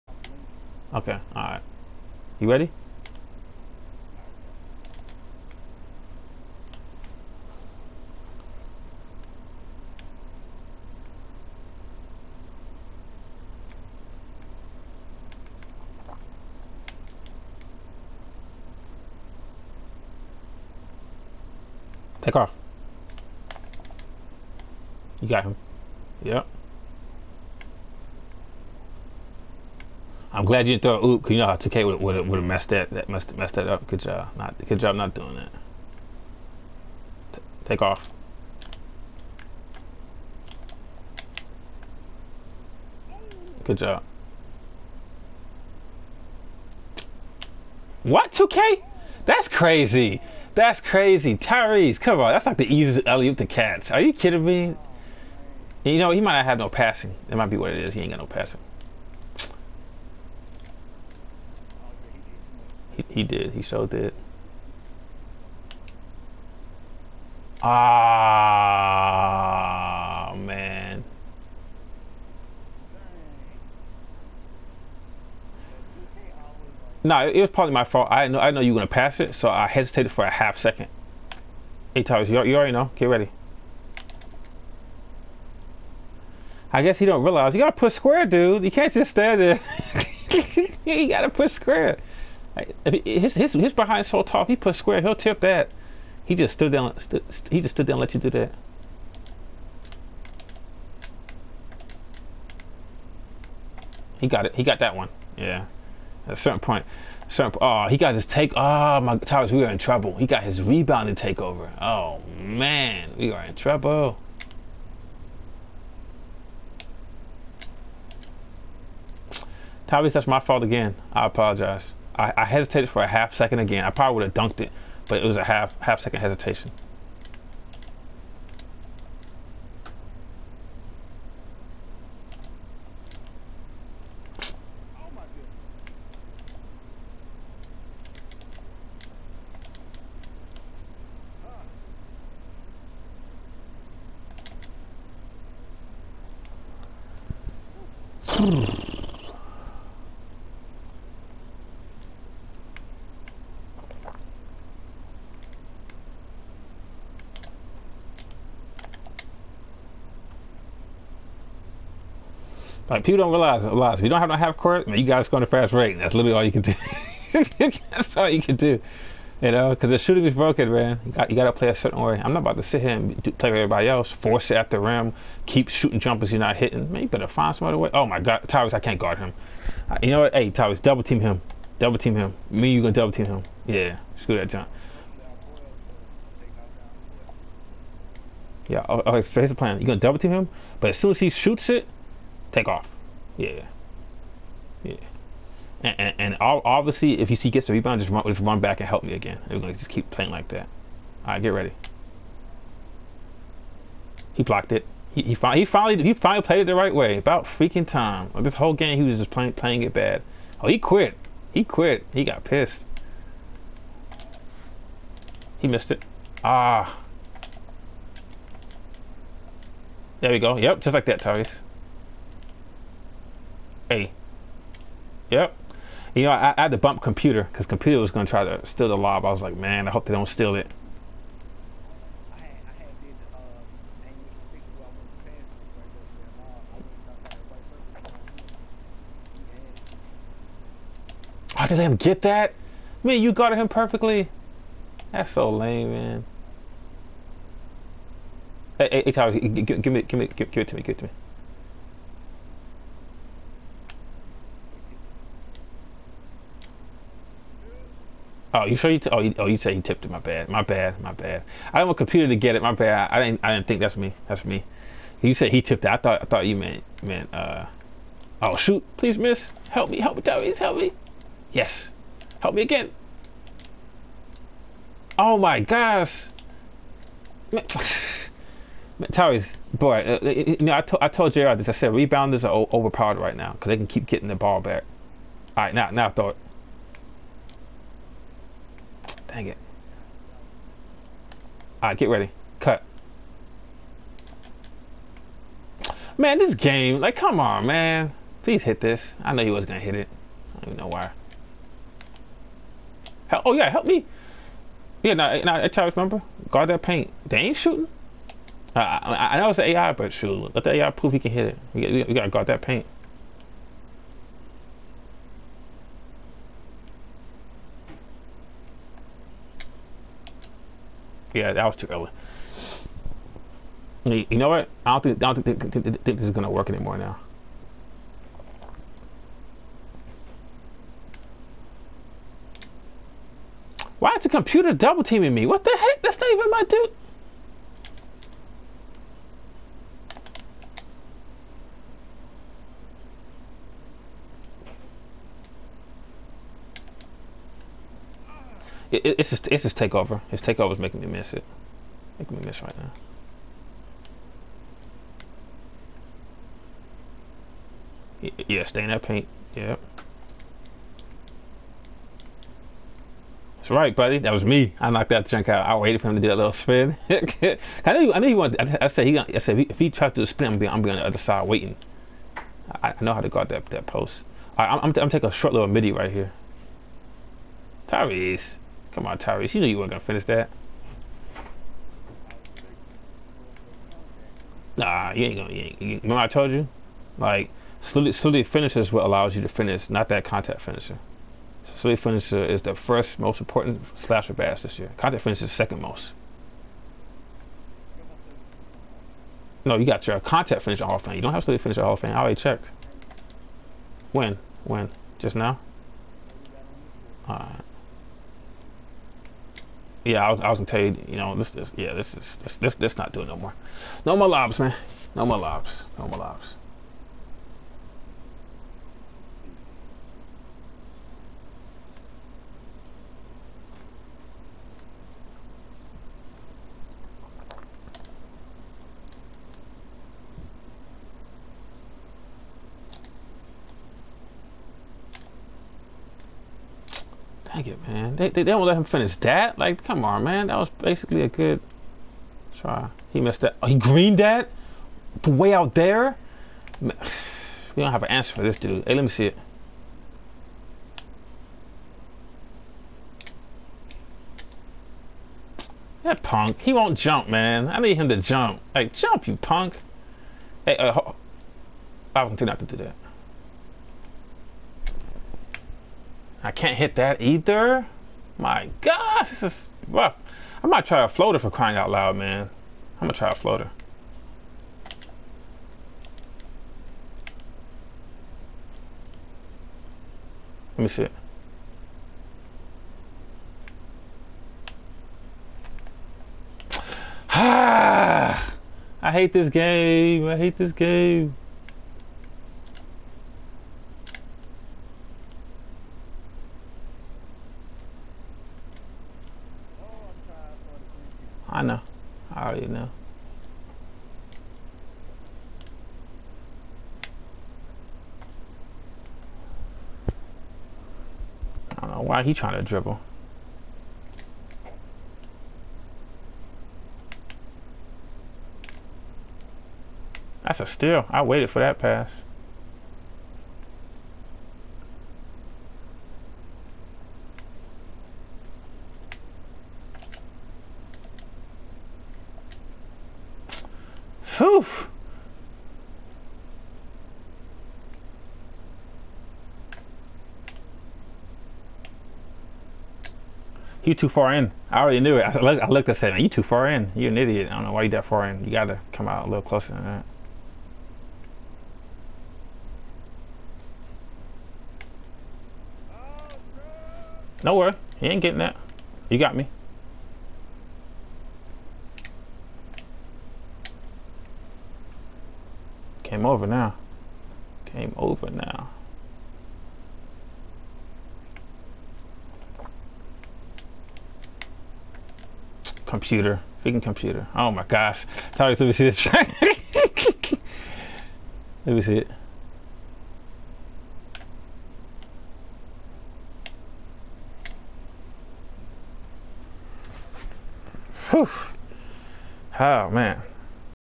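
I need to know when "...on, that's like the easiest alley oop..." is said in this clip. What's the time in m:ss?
0:52.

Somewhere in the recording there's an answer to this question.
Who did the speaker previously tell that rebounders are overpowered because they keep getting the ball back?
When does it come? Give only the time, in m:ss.
4:41.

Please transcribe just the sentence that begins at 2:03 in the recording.
I probably would have dunked it, but it was a half half second hesitation.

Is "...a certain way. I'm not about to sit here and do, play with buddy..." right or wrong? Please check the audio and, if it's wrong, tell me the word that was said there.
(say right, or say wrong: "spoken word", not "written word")
wrong: "everybody", not "buddy".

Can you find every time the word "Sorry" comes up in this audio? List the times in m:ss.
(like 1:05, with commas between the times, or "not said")
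9:38.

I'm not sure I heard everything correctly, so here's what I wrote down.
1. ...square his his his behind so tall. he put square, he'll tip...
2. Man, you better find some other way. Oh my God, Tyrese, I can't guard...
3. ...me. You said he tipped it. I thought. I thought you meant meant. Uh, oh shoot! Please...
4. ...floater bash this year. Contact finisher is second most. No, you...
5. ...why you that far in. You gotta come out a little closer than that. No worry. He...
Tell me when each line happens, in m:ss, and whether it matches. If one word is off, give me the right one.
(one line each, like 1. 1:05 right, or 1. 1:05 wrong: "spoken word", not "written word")
1. 1:31 right
2. 2:56 right
3. 4:24 right
4. 6:33 wrong: "slasher", not "floater"
5. 9:07 right.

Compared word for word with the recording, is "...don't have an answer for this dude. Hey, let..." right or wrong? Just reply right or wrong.
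right.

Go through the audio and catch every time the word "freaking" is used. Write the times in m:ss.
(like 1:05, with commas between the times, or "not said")
3:27, 9:36.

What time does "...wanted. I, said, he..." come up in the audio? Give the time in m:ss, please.
6:08.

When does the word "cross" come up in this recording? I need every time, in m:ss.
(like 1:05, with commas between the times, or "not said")
not said.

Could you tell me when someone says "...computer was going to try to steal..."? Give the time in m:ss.
3:47.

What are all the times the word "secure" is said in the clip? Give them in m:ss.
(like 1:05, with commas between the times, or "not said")
not said.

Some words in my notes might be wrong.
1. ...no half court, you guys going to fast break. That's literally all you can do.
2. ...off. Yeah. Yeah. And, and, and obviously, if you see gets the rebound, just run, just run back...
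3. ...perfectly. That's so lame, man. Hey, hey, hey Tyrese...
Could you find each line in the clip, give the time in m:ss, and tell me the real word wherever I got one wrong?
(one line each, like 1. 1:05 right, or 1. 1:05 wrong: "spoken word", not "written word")
1. 2:44 right
2. 3:12 right
3. 4:03 wrong: "Tyler", not "Tyrese".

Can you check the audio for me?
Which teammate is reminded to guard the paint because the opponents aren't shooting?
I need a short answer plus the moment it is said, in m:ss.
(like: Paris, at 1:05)
Charles, at 5:05.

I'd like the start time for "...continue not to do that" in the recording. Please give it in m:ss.
7:42.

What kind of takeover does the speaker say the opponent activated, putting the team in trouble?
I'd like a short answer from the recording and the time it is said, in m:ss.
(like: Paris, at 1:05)
rebounding takeover, at 1:50.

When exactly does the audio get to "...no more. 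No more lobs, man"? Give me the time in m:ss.
6:53.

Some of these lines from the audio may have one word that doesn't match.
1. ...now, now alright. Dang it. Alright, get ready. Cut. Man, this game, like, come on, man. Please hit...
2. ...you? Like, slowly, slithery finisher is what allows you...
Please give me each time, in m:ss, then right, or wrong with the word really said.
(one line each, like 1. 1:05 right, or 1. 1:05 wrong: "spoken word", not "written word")
1. 4:45 wrong: "thought", not "alright"
2. 6:26 right.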